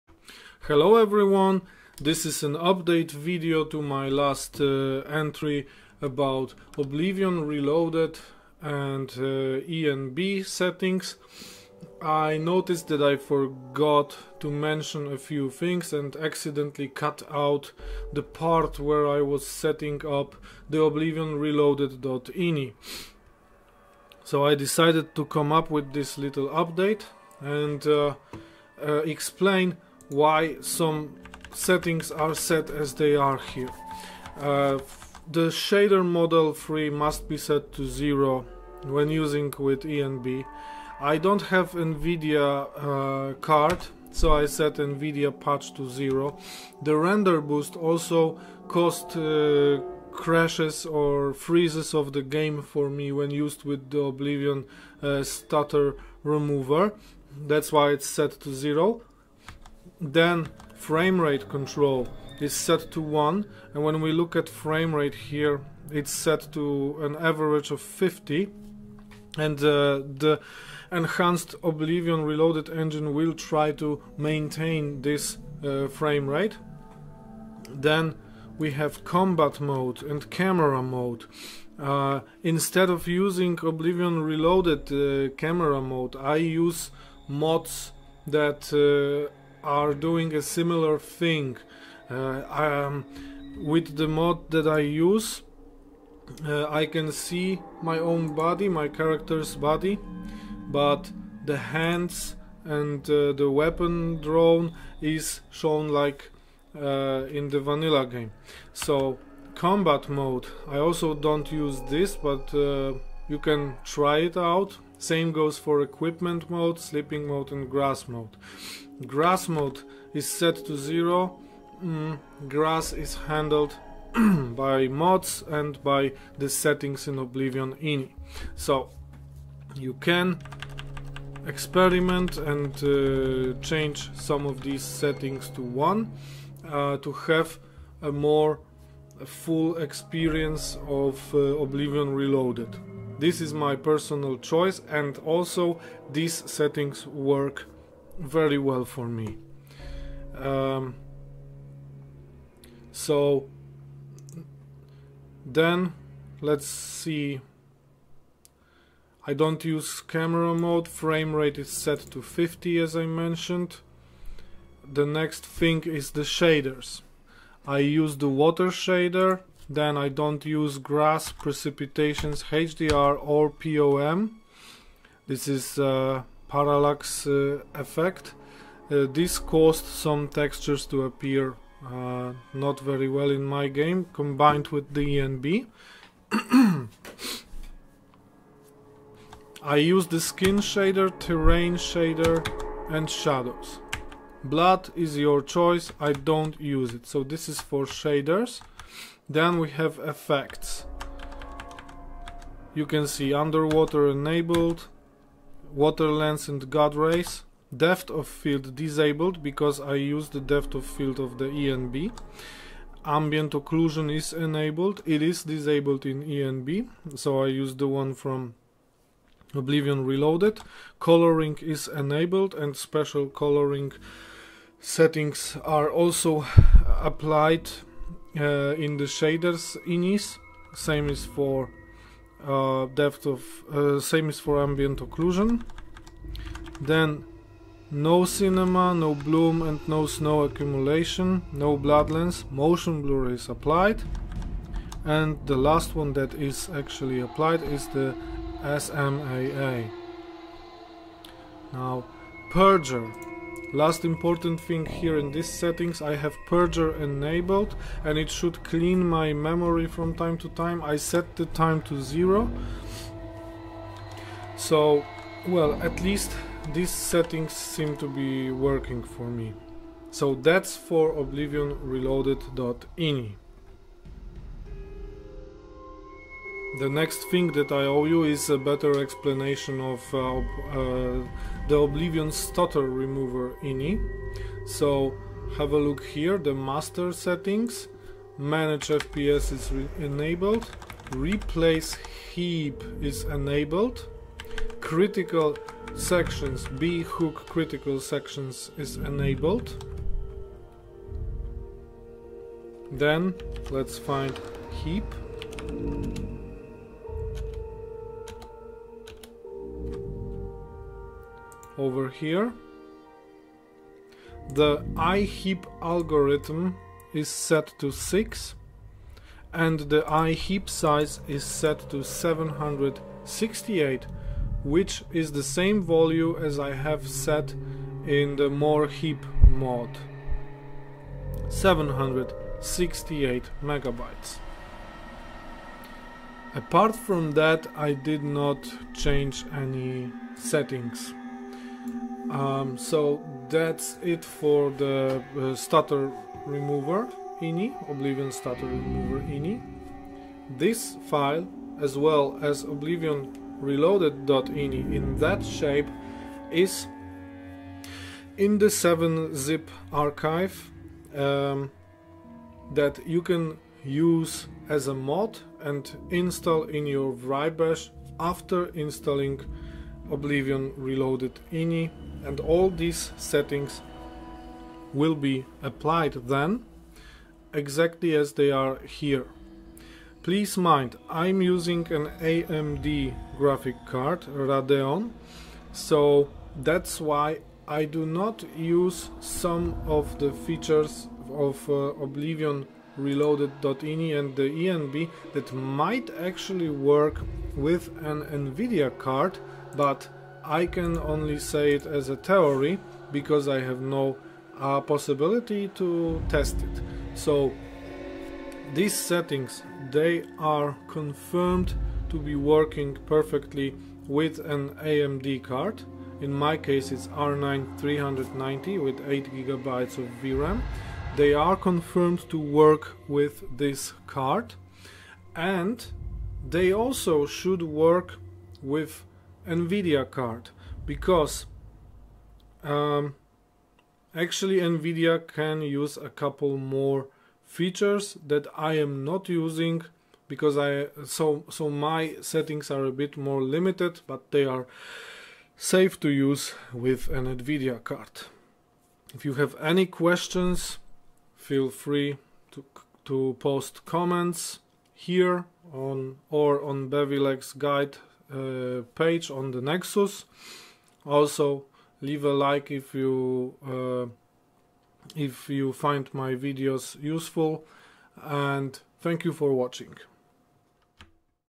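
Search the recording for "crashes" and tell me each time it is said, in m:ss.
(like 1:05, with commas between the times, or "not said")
0:50.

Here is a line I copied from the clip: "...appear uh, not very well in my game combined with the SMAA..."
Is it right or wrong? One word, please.
wrong.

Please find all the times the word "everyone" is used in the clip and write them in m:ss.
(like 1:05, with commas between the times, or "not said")
0:00.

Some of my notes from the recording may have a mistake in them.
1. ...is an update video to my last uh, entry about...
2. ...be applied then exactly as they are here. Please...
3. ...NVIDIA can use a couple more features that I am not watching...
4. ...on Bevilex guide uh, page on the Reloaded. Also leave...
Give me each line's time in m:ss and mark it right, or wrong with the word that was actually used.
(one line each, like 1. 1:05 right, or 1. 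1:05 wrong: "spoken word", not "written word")
1. 0:02 right
2. 6:15 right
3. 7:14 wrong: "using", not "watching"
4. 7:36 wrong: "Nexus", not "Reloaded".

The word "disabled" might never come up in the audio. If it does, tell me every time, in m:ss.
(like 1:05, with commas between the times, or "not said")
3:28, 3:35.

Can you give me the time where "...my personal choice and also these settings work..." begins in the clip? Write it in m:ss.
2:23.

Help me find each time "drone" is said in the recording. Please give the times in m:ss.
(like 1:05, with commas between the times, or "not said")
1:44.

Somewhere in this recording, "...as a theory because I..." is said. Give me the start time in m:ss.
6:41.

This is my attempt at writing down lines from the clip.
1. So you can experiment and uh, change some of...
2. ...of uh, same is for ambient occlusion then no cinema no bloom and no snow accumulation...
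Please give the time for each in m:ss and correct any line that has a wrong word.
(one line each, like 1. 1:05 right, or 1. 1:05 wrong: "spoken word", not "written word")
1. 2:08 right
2. 3:53 right.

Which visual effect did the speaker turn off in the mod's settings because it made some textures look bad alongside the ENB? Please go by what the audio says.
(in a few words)
POM.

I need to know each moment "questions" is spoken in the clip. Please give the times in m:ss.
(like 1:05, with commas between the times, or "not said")
7:29.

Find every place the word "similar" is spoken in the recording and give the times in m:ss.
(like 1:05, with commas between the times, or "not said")
1:30.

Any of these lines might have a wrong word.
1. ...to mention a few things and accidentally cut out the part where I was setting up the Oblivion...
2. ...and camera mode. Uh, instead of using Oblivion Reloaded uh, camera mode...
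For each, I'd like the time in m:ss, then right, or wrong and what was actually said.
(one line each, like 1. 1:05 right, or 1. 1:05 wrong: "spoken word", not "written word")
1. 0:14 right
2. 1:20 right.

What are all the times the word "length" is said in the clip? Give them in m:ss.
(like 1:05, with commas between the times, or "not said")
not said.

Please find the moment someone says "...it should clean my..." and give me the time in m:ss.
4:18.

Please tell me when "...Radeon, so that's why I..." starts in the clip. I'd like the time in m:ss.
6:24.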